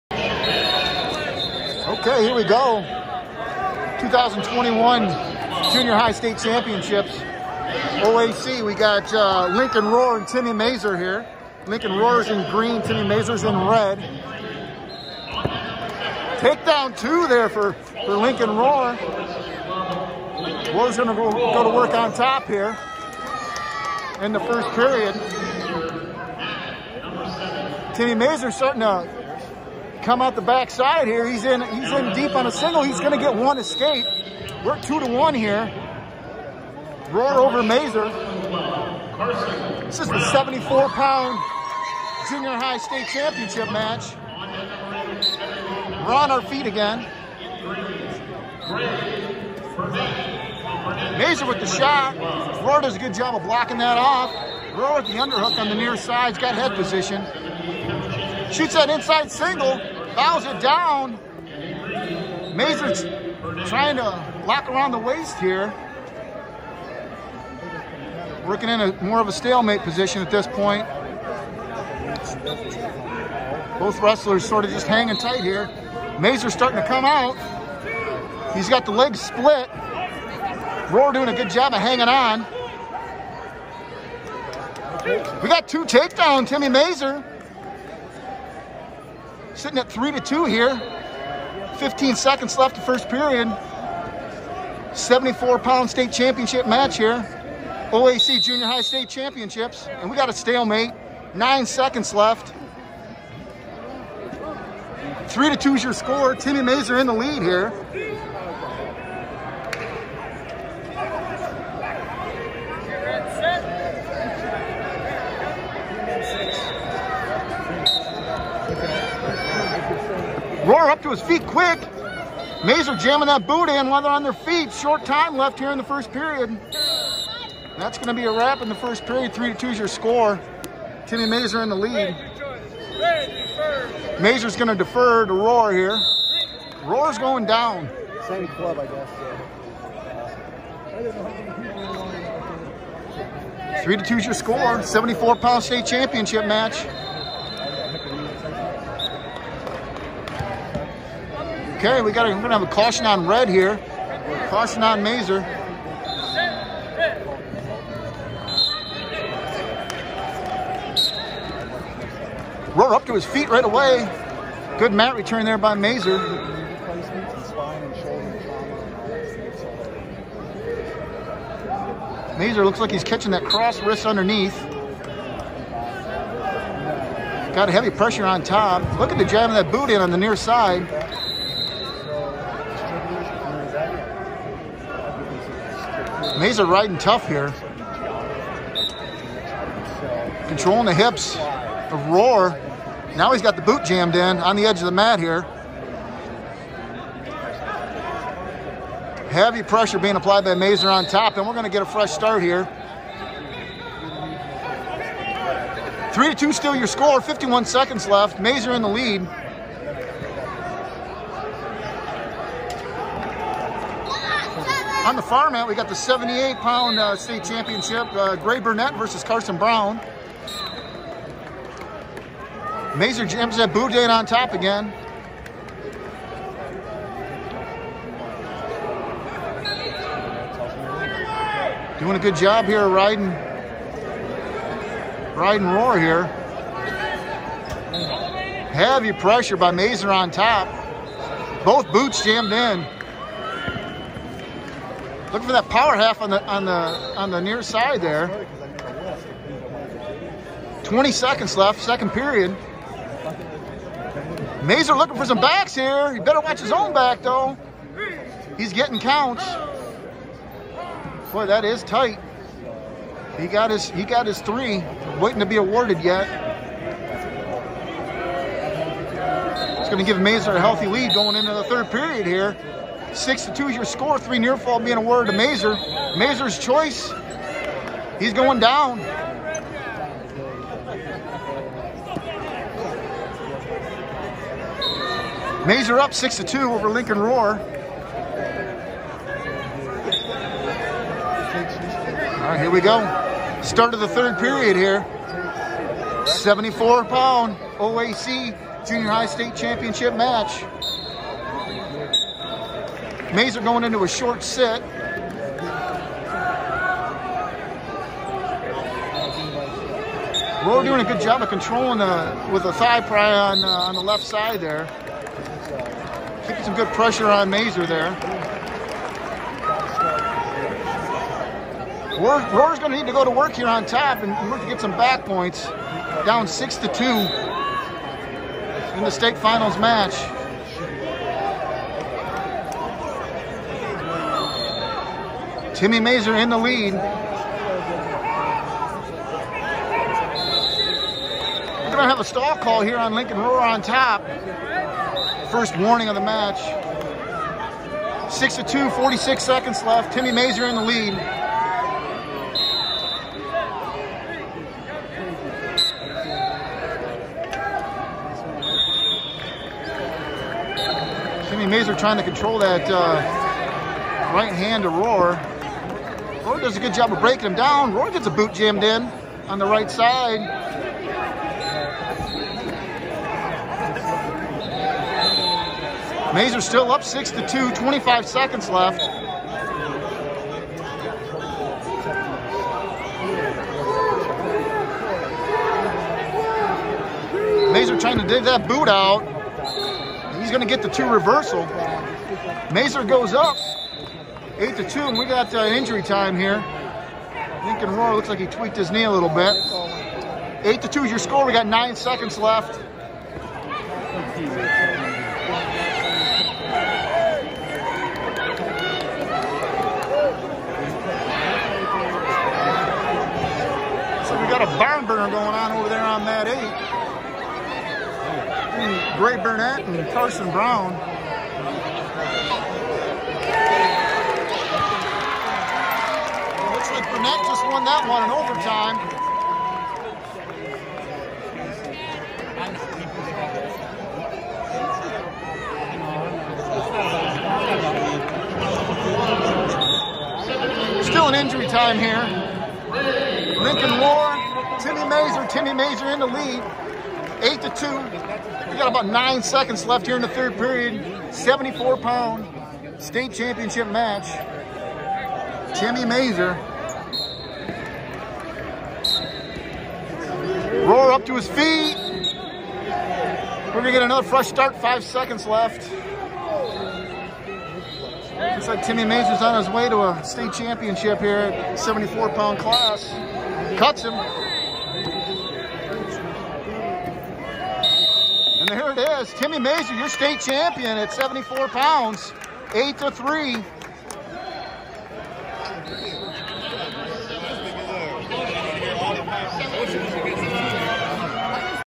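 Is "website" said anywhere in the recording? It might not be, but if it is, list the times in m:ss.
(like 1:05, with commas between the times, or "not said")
not said.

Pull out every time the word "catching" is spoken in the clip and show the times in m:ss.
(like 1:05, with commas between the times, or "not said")
2:53.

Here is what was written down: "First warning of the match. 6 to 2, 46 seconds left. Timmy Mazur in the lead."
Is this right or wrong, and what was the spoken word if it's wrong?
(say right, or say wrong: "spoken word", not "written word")
right.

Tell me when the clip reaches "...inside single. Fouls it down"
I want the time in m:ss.
0:58.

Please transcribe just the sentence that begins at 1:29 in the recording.
Sitting at three to two here.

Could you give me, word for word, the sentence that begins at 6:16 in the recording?
Mazur still up 6 to 2, 25 seconds left.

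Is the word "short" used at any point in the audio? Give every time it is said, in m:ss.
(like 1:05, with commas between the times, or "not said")
2:04, 5:04.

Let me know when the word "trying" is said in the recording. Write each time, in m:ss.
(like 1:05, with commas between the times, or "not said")
1:03, 6:01, 6:27.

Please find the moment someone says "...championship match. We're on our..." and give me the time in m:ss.
0:43.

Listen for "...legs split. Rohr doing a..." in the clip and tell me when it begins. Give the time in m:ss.
1:18.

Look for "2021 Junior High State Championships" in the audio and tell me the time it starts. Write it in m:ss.
0:03.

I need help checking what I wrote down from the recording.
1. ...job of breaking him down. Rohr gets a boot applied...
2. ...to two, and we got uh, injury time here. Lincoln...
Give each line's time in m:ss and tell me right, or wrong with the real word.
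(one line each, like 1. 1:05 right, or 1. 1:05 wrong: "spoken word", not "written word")
1. 6:06 wrong: "jammed", not "applied"
2. 6:34 right.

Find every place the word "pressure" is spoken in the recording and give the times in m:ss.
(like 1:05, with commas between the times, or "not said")
2:57, 3:19, 3:59, 5:16.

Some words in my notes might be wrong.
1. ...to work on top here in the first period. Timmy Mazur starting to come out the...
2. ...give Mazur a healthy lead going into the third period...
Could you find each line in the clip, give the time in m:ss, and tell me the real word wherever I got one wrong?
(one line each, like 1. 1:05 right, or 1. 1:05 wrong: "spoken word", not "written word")
1. 0:21 right
2. 4:30 right.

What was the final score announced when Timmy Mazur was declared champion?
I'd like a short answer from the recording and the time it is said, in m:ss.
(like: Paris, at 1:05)
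8 to 3, at 8:02.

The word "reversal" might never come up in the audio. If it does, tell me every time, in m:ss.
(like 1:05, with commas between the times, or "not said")
6:31.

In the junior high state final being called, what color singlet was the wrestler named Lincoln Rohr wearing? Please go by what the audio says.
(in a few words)
Green.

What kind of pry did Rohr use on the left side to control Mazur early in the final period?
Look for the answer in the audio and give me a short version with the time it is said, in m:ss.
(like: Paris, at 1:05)
Thigh pry, at 5:12.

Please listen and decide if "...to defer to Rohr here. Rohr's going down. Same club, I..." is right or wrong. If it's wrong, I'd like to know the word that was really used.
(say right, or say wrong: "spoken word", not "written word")
right.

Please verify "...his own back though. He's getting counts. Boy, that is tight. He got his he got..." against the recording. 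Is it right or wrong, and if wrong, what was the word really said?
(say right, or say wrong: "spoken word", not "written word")
right.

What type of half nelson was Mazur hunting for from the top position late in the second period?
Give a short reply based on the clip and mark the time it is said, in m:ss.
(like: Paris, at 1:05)
Power half, at 4:05.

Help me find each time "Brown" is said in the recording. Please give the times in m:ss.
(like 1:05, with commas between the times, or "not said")
3:39, 7:00.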